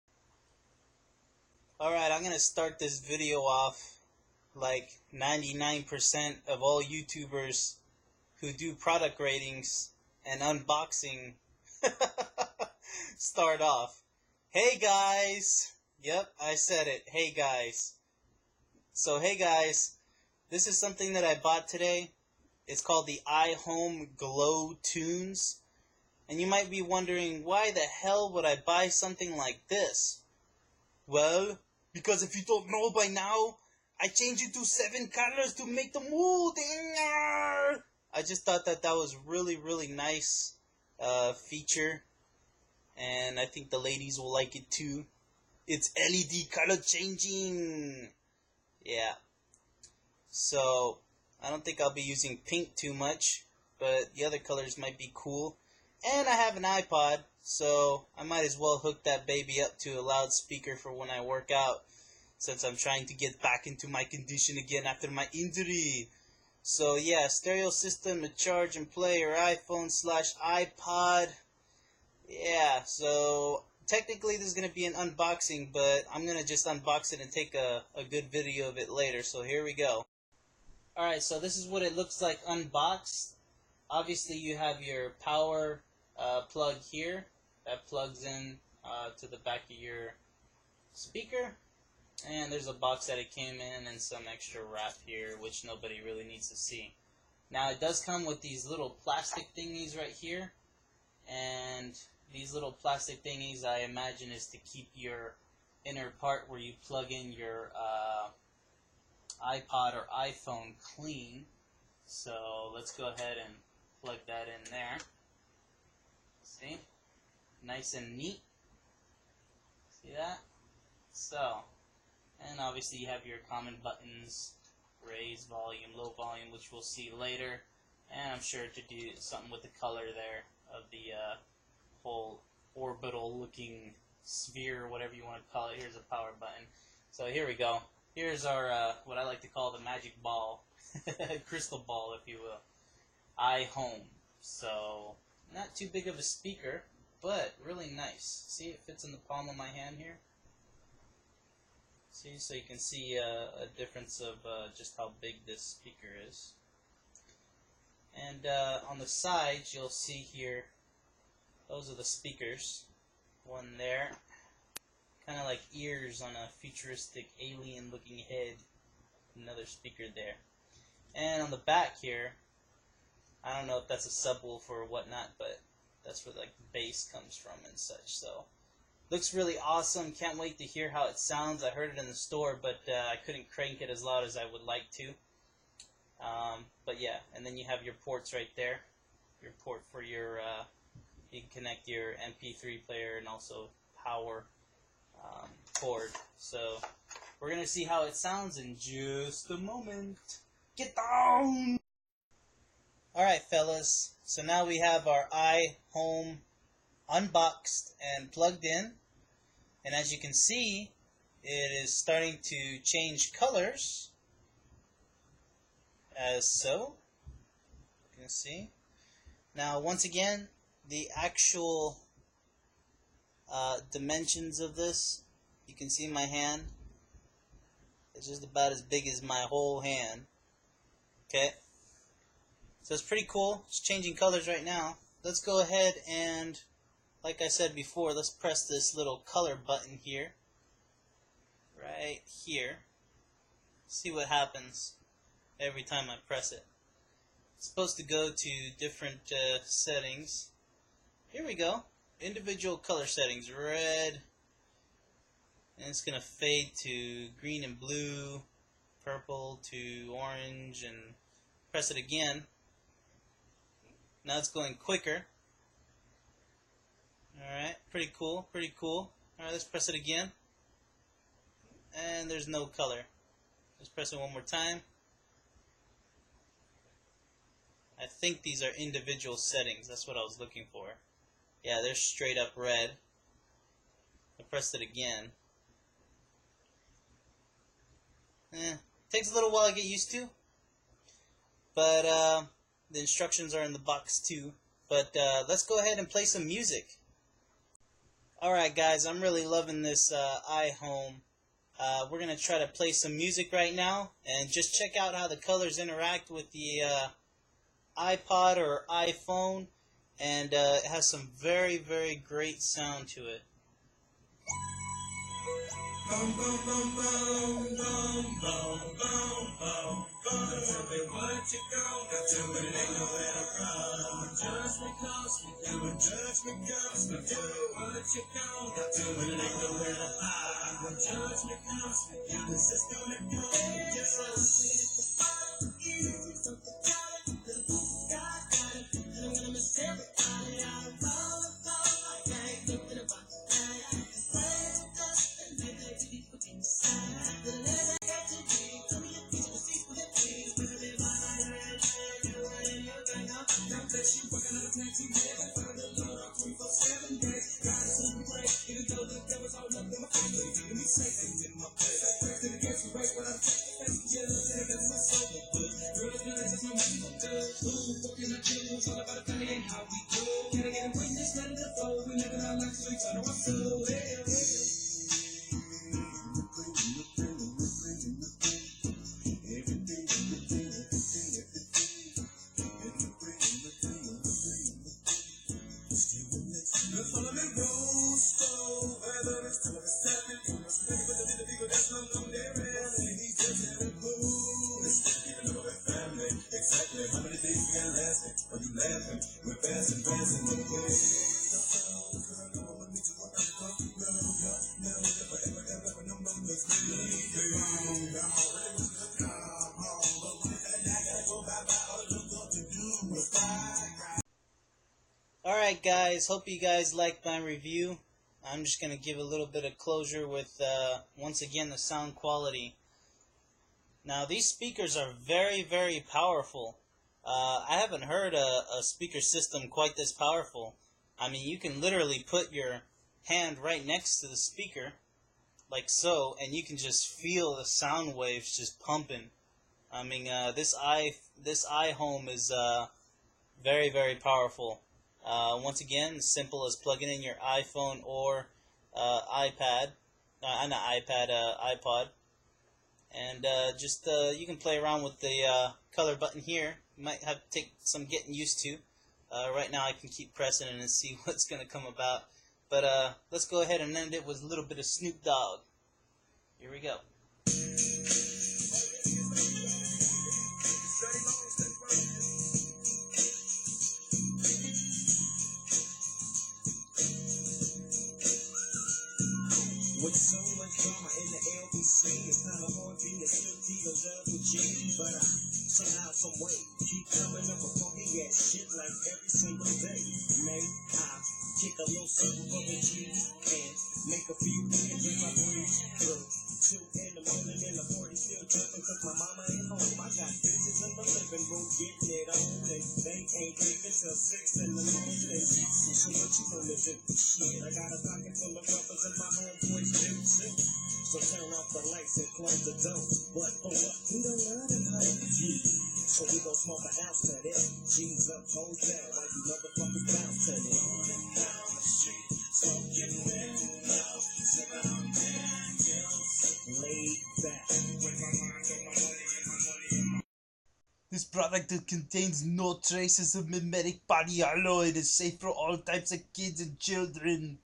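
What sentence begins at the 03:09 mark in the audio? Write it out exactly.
Your port for your uh, you can connect your MP3 player and also power um, cord.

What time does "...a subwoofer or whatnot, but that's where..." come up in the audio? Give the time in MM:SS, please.
02:54.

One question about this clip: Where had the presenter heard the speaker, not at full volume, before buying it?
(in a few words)
the store.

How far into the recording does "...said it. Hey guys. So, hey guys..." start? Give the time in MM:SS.
00:16.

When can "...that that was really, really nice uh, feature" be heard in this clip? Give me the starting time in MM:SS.
00:38.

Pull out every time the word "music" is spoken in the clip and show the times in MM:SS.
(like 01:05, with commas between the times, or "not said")
04:56, 05:03.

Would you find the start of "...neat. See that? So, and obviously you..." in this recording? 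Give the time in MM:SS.
01:58.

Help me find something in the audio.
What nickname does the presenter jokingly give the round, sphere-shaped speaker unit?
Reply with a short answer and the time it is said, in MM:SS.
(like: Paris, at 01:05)
the magic ball, at 02:19.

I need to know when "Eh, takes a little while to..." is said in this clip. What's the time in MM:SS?
04:48.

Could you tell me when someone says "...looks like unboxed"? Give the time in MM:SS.
01:21.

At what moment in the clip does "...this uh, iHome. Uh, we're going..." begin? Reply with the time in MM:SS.
04:59.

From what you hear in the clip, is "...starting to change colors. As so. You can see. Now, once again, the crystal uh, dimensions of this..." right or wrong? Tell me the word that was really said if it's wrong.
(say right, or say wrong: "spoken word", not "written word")
wrong: "actual", not "crystal".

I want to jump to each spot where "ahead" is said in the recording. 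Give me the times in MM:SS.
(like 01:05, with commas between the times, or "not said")
01:53, 03:55, 04:55, 07:43.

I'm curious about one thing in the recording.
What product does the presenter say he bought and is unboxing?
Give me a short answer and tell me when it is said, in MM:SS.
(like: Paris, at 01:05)
iHome Glow Tunes, at 00:23.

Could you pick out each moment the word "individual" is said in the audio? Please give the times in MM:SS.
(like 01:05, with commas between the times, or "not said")
04:12, 04:38.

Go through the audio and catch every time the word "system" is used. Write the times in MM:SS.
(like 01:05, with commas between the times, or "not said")
01:07, 07:09.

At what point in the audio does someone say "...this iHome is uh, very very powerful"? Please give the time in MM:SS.
07:21.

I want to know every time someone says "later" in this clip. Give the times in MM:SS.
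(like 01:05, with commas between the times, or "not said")
01:18, 02:07.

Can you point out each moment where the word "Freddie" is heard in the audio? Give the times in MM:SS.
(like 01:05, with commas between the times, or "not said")
not said.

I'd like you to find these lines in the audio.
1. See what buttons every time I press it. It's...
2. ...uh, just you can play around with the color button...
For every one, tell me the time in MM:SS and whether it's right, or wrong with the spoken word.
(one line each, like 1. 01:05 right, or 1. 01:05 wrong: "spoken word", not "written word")
1. 04:03 wrong: "happens", not "buttons"
2. 07:33 right.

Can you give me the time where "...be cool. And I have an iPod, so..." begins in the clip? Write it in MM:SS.
00:54.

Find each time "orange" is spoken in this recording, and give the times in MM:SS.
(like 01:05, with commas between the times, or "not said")
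04:20.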